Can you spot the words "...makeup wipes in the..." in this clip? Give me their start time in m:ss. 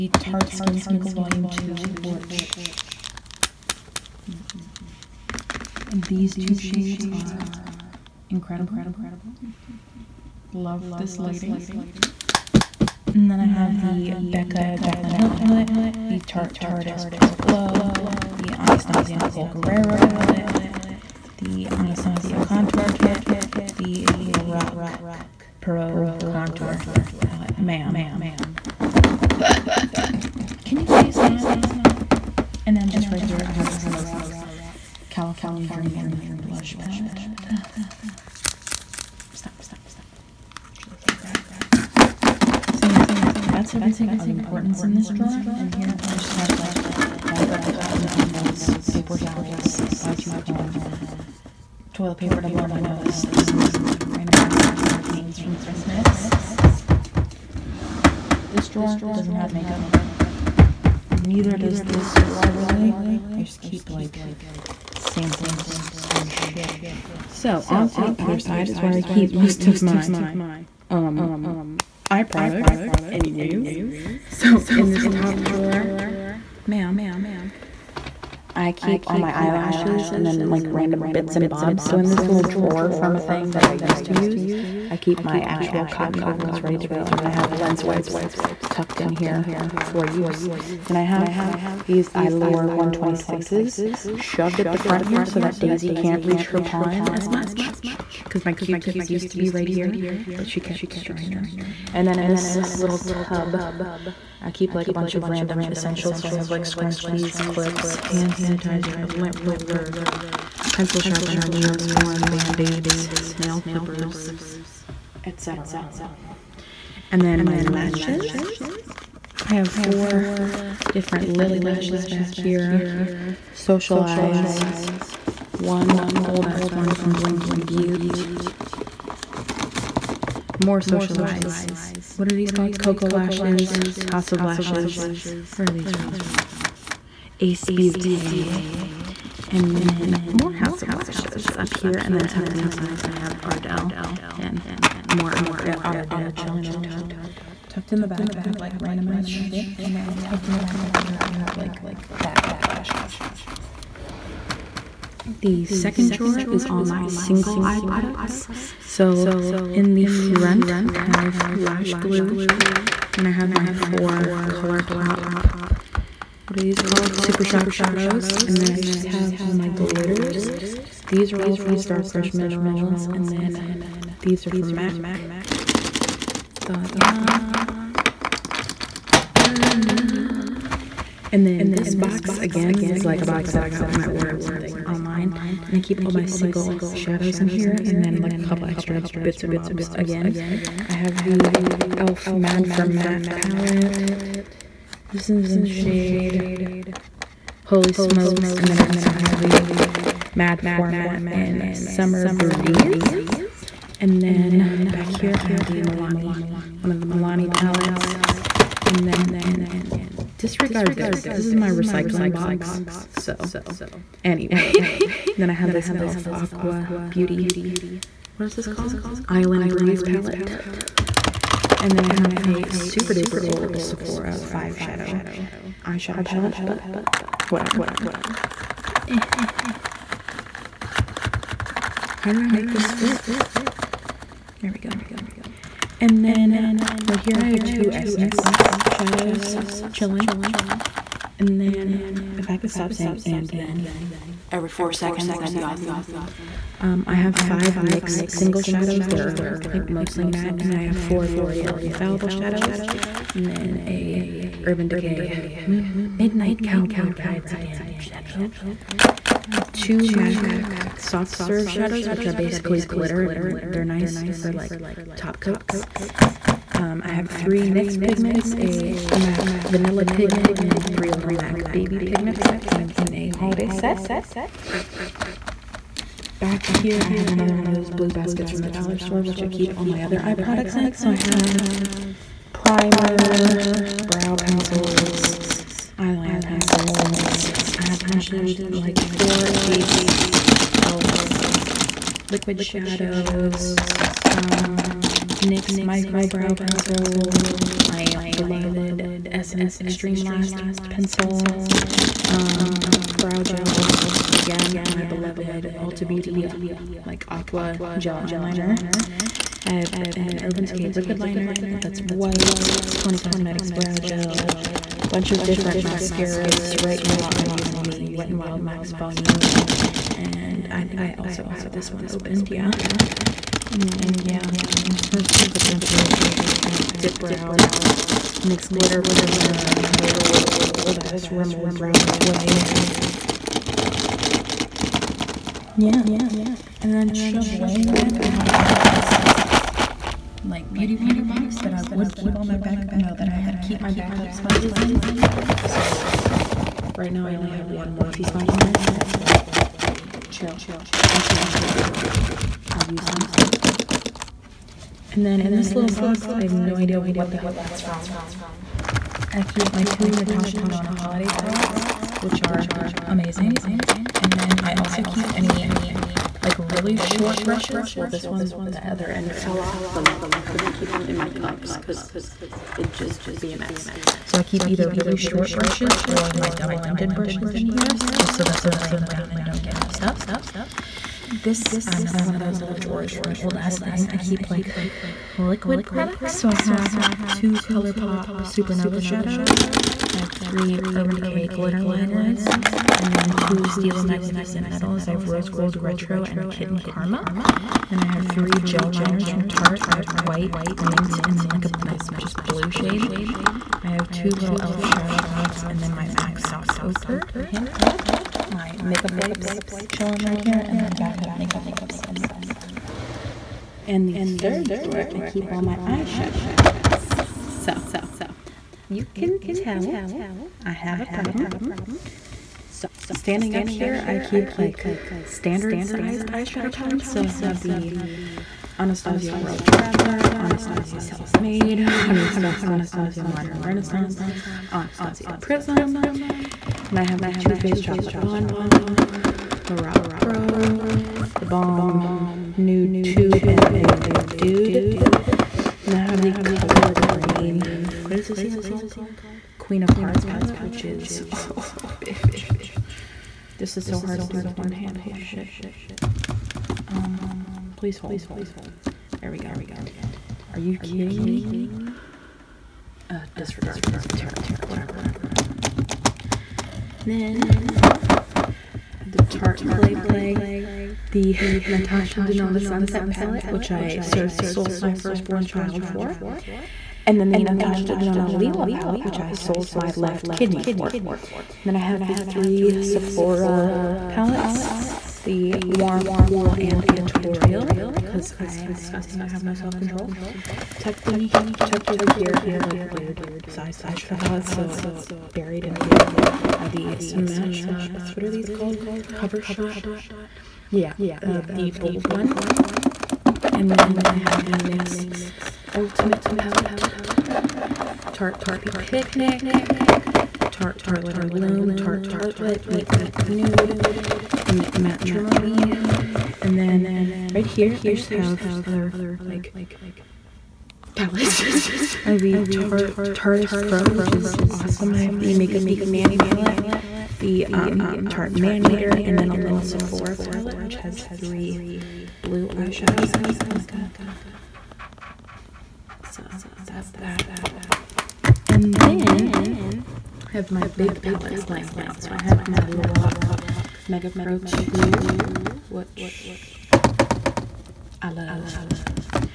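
6:51.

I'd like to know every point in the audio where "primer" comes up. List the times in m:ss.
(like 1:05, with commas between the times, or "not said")
4:42, 5:29.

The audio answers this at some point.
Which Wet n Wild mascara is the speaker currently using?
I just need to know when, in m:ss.
5:18.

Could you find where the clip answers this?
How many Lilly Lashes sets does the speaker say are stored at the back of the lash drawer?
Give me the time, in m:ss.
1:59.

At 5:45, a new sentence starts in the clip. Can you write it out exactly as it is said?
So right now I only have one Morphe sponge in there, but that's where they chill until i use them.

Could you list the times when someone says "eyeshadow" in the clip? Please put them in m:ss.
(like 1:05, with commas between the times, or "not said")
3:45, 6:55, 7:06, 8:13, 8:52.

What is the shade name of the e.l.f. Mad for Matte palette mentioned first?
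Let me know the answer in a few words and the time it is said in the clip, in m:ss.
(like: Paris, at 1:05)
Holy Smokes, at 3:17.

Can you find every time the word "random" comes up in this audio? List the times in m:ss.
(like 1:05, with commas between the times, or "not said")
0:54, 1:20, 1:45, 2:28.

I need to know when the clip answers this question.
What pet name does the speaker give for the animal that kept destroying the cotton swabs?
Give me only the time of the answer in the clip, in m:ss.
1:35.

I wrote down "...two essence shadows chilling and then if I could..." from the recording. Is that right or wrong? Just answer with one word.
right.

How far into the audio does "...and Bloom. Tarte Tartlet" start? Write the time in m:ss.
8:31.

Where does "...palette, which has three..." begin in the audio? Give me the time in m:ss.
8:50.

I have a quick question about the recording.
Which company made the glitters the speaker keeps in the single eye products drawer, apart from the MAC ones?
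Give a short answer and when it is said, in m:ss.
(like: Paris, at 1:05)
Star Crush Minerals, at 2:51.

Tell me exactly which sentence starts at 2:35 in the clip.
The second drawer is all my single eye products.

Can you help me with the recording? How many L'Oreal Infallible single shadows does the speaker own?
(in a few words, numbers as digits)
4.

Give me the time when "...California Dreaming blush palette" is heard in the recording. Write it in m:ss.
0:35.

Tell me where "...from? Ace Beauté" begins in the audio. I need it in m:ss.
2:15.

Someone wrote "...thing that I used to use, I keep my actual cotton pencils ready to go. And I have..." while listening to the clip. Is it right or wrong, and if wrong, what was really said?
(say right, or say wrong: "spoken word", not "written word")
wrong: "ovals", not "pencils".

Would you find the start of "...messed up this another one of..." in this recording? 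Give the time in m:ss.
6:19.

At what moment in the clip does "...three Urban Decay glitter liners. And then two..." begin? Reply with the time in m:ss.
6:30.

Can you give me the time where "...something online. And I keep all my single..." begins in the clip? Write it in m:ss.
3:04.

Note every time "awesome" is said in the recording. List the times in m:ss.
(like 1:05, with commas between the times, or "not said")
4:05, 8:44.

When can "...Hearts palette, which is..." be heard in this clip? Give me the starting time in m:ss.
7:29.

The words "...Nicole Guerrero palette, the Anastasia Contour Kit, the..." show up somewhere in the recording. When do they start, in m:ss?
0:19.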